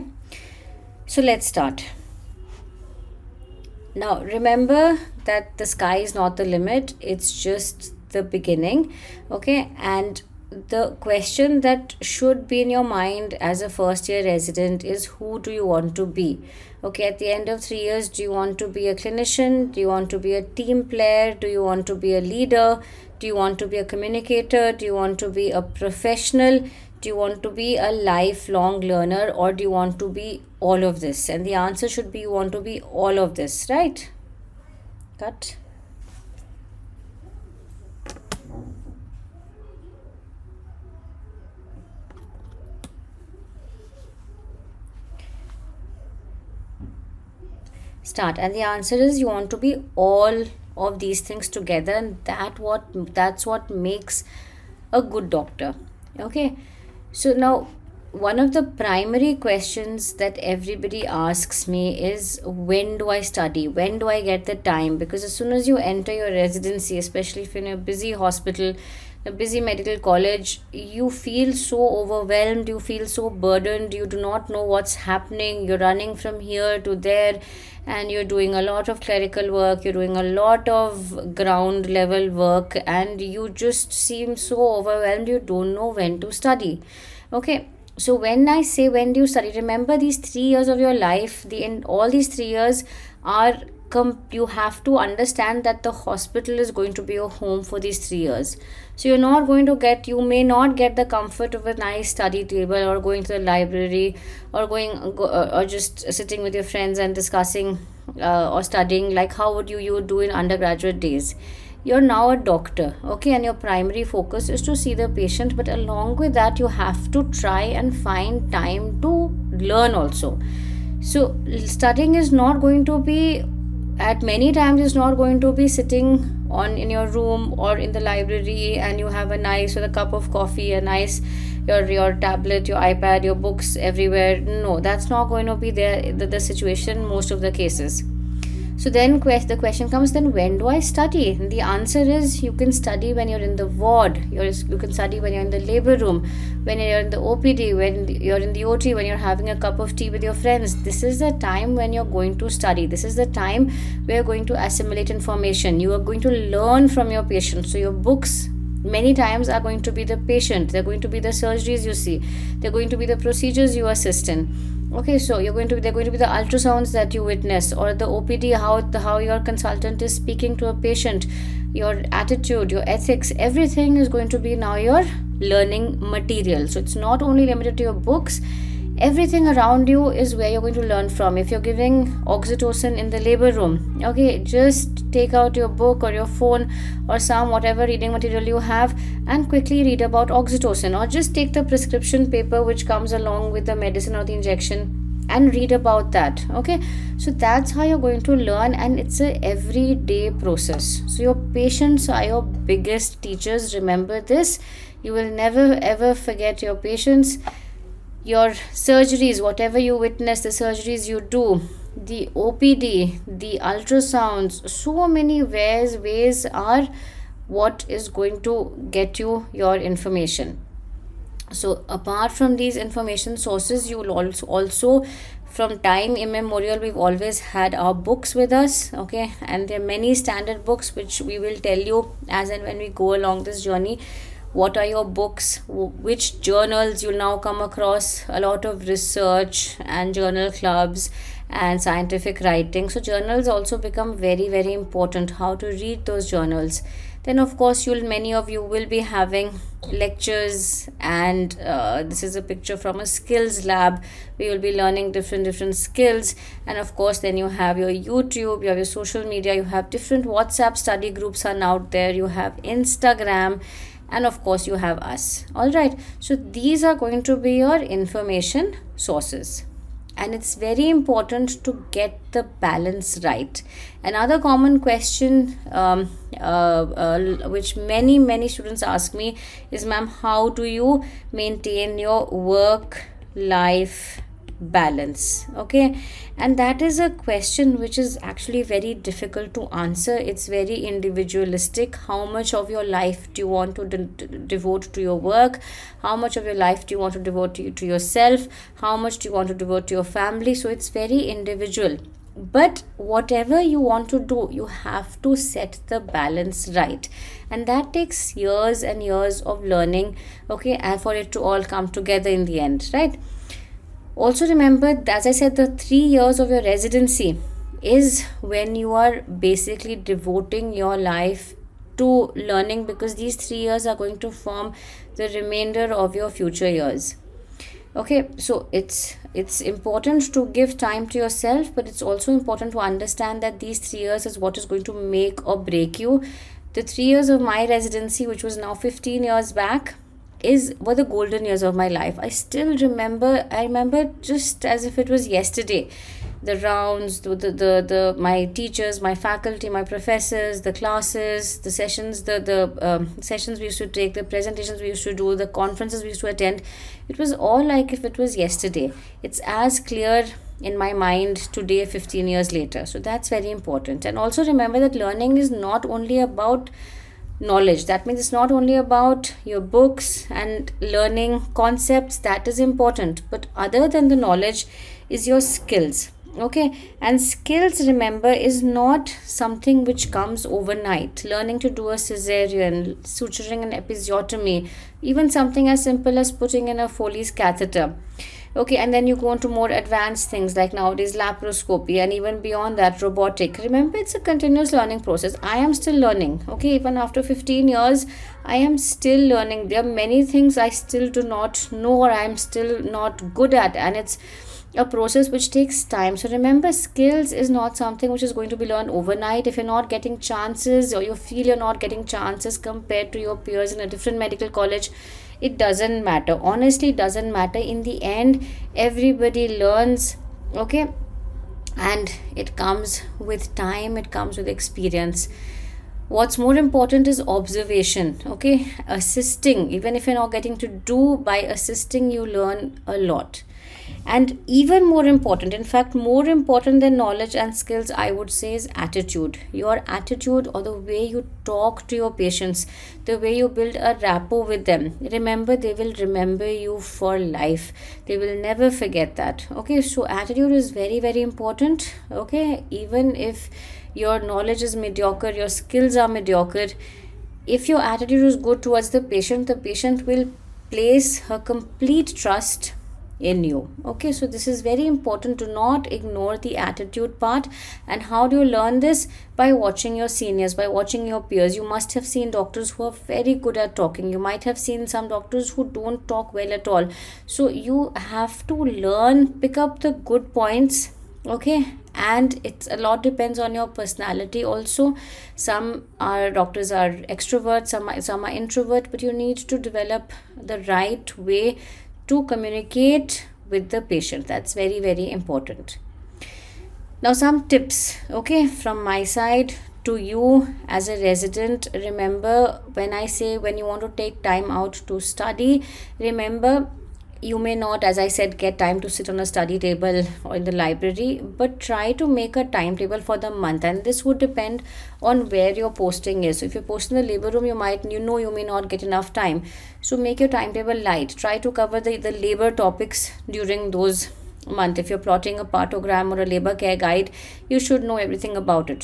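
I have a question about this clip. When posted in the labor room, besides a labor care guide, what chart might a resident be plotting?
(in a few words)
Partogram.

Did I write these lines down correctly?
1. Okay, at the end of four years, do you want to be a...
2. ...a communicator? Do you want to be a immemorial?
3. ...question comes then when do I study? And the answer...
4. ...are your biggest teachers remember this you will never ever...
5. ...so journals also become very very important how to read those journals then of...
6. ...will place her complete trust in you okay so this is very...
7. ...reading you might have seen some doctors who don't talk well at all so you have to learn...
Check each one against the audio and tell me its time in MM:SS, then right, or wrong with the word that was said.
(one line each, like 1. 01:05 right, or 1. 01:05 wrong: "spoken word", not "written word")
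1. 00:16 wrong: "three", not "four"
2. 00:23 wrong: "professional", not "immemorial"
3. 02:19 right
4. 03:22 right
5. 04:02 right
6. 07:40 right
7. 07:53 wrong: "talking", not "reading".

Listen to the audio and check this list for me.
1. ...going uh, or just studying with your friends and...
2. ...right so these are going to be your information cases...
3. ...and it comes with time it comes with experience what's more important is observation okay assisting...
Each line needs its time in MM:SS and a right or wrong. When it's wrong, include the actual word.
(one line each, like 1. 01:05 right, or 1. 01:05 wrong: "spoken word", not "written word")
1. 01:44 wrong: "sitting", not "studying"
2. 04:25 wrong: "sources", not "cases"
3. 07:01 right.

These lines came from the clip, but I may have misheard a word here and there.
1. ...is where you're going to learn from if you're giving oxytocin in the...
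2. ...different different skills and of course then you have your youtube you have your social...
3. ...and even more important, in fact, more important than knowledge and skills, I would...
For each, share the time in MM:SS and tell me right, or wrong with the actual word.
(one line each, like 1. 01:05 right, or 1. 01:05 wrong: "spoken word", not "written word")
1. 03:00 right
2. 04:15 right
3. 07:14 right.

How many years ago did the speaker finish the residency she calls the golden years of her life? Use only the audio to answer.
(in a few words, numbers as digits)
15.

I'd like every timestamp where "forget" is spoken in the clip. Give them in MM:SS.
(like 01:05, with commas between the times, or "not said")
03:26, 07:28.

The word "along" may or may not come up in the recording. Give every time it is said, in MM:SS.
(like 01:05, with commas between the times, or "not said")
01:55, 03:13, 03:53.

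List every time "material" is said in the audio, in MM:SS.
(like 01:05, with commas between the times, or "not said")
02:56, 03:08.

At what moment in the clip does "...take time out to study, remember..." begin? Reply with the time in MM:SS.
08:23.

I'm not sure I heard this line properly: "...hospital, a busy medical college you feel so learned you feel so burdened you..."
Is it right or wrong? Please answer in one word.
wrong.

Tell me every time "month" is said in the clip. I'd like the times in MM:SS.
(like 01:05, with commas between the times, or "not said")
08:33, 08:44.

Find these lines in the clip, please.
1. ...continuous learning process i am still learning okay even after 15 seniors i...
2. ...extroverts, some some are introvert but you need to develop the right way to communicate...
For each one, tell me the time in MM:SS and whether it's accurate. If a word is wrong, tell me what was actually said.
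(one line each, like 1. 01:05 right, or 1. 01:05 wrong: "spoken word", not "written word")
1. 06:34 wrong: "years", not "seniors"
2. 08:07 right.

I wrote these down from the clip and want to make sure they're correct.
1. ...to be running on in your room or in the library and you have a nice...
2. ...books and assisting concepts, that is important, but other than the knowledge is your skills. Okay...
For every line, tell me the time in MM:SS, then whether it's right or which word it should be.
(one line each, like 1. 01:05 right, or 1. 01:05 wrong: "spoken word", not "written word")
1. 02:05 wrong: "sitting", not "running"
2. 06:09 wrong: "learning", not "assisting".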